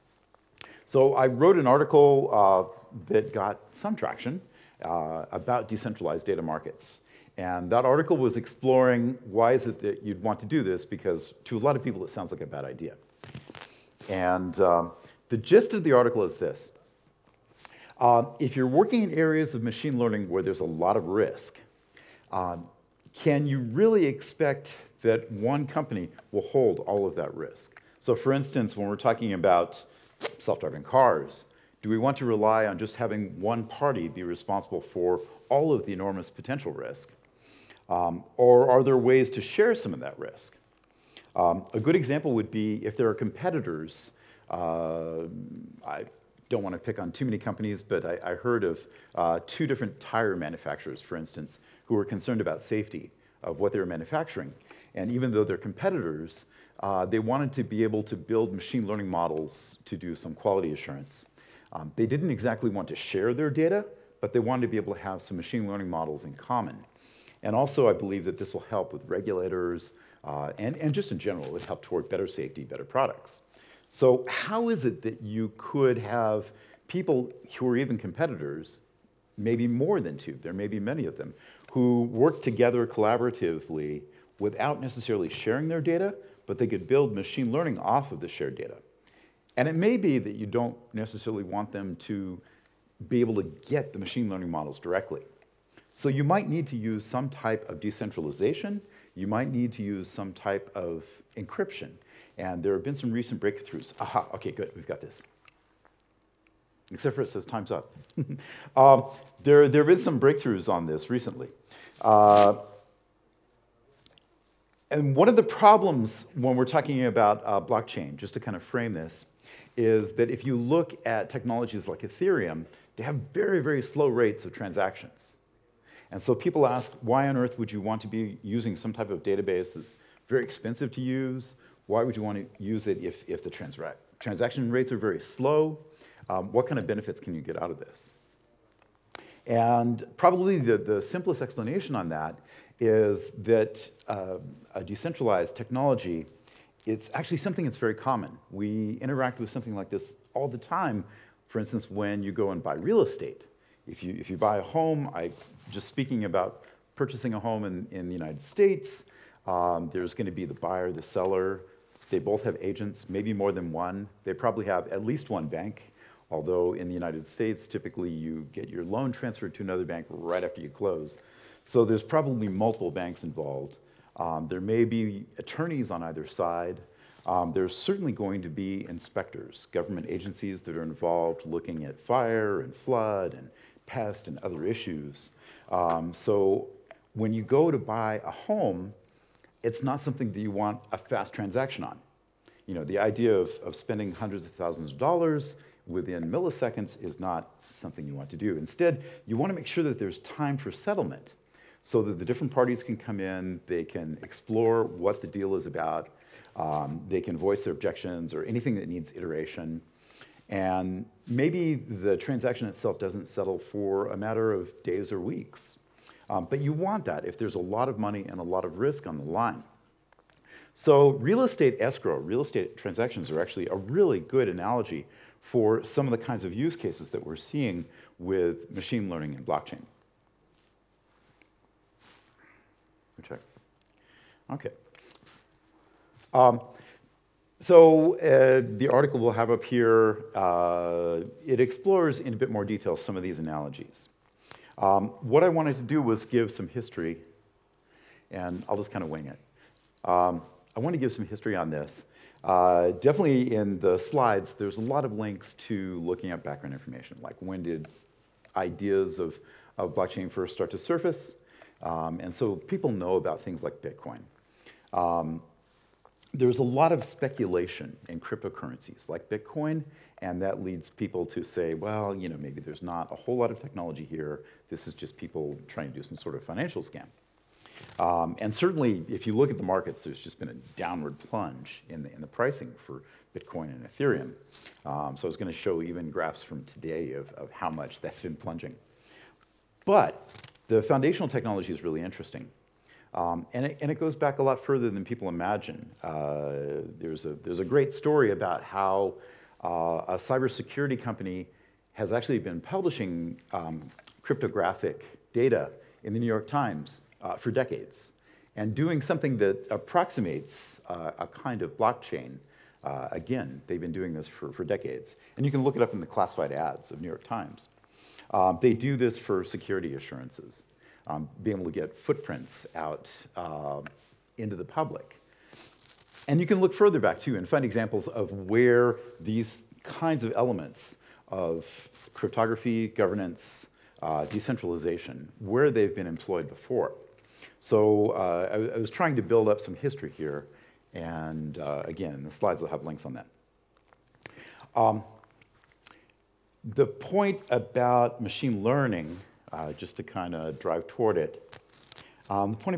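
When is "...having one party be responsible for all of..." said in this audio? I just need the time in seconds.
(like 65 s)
32 s.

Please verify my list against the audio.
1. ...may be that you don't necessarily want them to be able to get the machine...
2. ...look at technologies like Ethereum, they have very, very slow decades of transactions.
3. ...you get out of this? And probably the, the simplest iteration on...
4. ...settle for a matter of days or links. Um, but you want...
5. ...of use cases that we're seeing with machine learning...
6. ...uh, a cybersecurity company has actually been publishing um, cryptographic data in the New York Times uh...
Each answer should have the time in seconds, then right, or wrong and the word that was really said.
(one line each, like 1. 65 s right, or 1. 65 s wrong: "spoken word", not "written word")
1. 89 s right
2. 120 s wrong: "rates", not "decades"
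3. 137 s wrong: "explanation", not "iteration"
4. 213 s wrong: "weeks", not "links"
5. 226 s right
6. 299 s right.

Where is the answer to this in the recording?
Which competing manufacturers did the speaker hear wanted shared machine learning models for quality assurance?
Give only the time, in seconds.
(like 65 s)
49 s.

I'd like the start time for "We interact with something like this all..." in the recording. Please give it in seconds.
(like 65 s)
148 s.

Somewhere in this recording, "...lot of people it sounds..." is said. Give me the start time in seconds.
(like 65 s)
11 s.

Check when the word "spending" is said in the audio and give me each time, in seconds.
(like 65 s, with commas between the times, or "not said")
193 s.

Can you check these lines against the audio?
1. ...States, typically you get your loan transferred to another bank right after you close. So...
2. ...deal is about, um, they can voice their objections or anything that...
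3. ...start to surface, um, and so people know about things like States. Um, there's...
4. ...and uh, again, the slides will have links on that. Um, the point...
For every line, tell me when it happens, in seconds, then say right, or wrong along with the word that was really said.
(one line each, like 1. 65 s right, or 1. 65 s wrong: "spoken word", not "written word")
1. 167 s right
2. 205 s right
3. 260 s wrong: "Bitcoin", not "States"
4. 340 s right.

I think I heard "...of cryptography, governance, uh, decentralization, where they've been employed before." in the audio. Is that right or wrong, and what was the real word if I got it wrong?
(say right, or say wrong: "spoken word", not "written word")
right.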